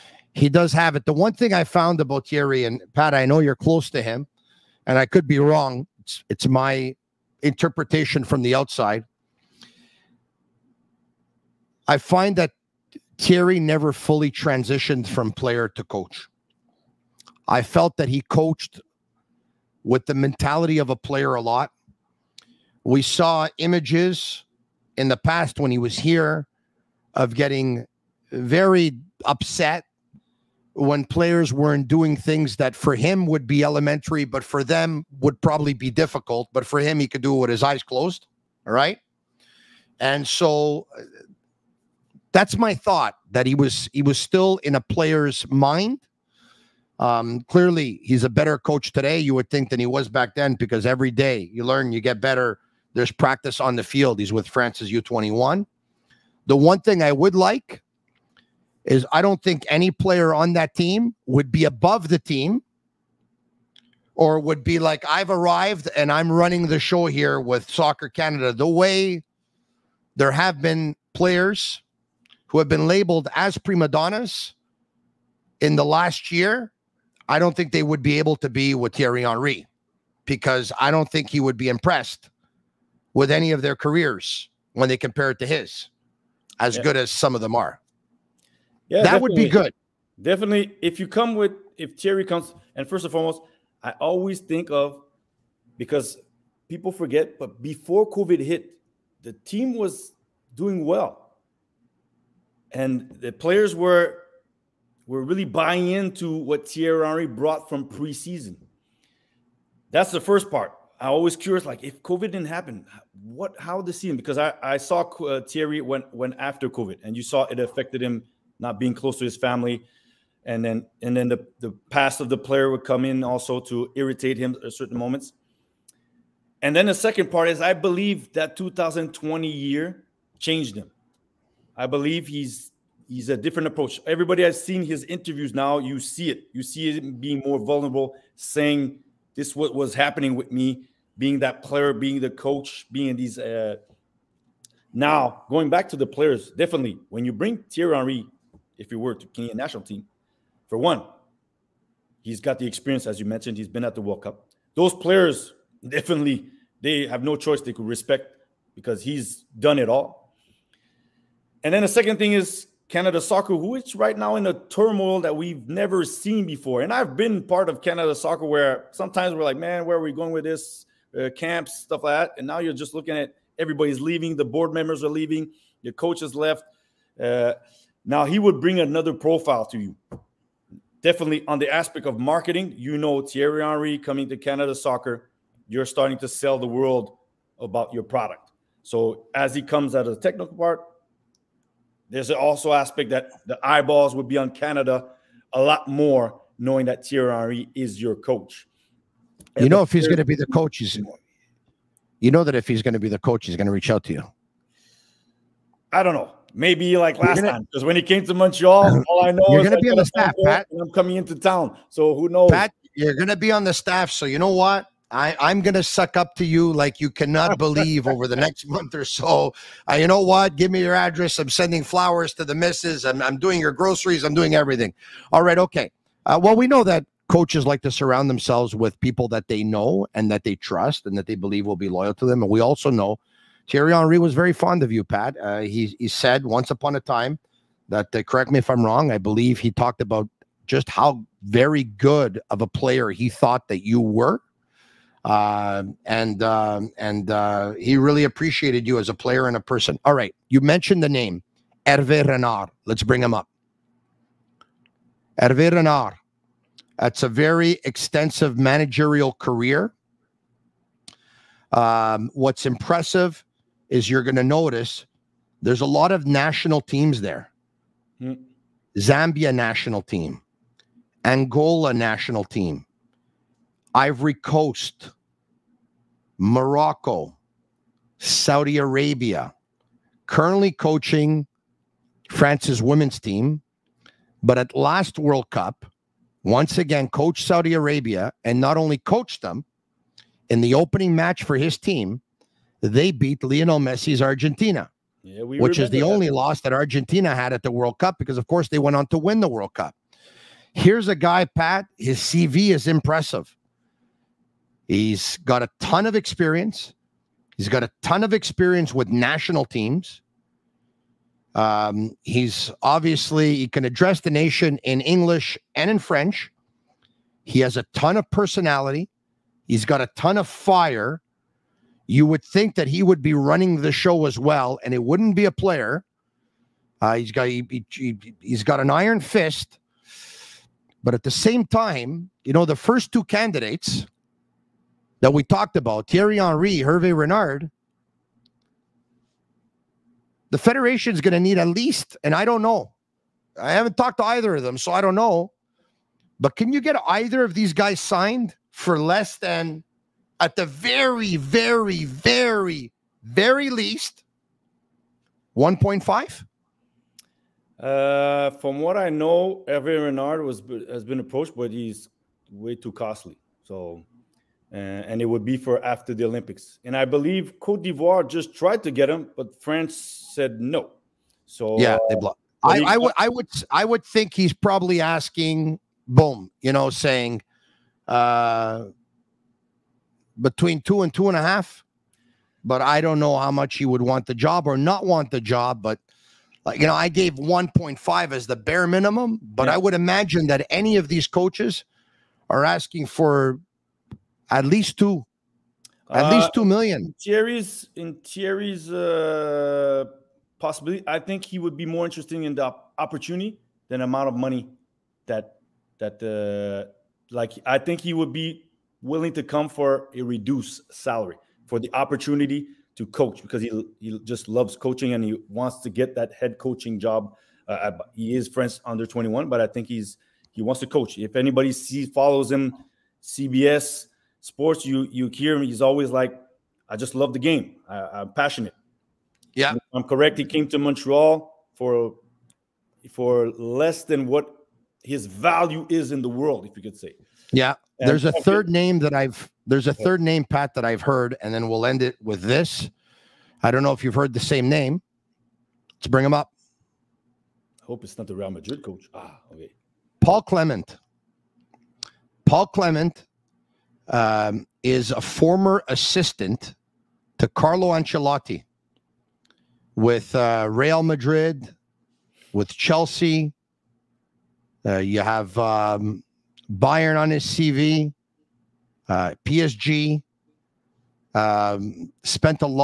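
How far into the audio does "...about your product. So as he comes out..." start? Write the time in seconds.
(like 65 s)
187 s.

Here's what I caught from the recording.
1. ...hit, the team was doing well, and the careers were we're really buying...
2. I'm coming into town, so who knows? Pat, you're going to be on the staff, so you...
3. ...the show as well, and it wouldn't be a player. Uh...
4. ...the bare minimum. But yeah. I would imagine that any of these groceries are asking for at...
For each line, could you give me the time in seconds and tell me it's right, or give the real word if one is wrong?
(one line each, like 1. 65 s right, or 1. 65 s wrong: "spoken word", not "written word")
1. 98 s wrong: "players", not "careers"
2. 210 s right
3. 323 s right
4. 388 s wrong: "coaches", not "groceries".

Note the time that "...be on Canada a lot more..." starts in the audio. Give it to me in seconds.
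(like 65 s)
194 s.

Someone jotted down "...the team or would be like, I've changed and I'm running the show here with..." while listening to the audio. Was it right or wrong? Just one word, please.
wrong.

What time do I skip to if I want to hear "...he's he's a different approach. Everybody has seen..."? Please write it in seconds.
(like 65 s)
132 s.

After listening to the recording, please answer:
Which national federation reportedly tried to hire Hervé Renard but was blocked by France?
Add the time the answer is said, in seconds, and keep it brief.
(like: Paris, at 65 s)
Cote d'Ivoire, at 367 s.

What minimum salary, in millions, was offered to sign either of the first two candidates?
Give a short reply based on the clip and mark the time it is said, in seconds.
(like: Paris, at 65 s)
1.5 million, at 355 s.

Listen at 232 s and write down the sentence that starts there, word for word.
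And we also know Thierry Henry was very fond of you, Pat.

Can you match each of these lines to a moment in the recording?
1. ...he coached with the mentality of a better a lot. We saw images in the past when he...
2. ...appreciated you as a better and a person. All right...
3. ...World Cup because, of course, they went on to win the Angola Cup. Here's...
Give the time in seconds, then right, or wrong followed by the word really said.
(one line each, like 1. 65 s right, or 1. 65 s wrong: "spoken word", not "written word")
1. 18 s wrong: "player", not "better"
2. 248 s wrong: "player", not "better"
3. 297 s wrong: "World", not "Angola".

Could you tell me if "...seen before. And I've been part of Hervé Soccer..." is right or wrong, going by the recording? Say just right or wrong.
wrong.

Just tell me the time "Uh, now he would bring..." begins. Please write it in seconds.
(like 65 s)
177 s.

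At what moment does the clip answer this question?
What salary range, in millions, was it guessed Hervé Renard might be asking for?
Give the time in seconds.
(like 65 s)
380 s.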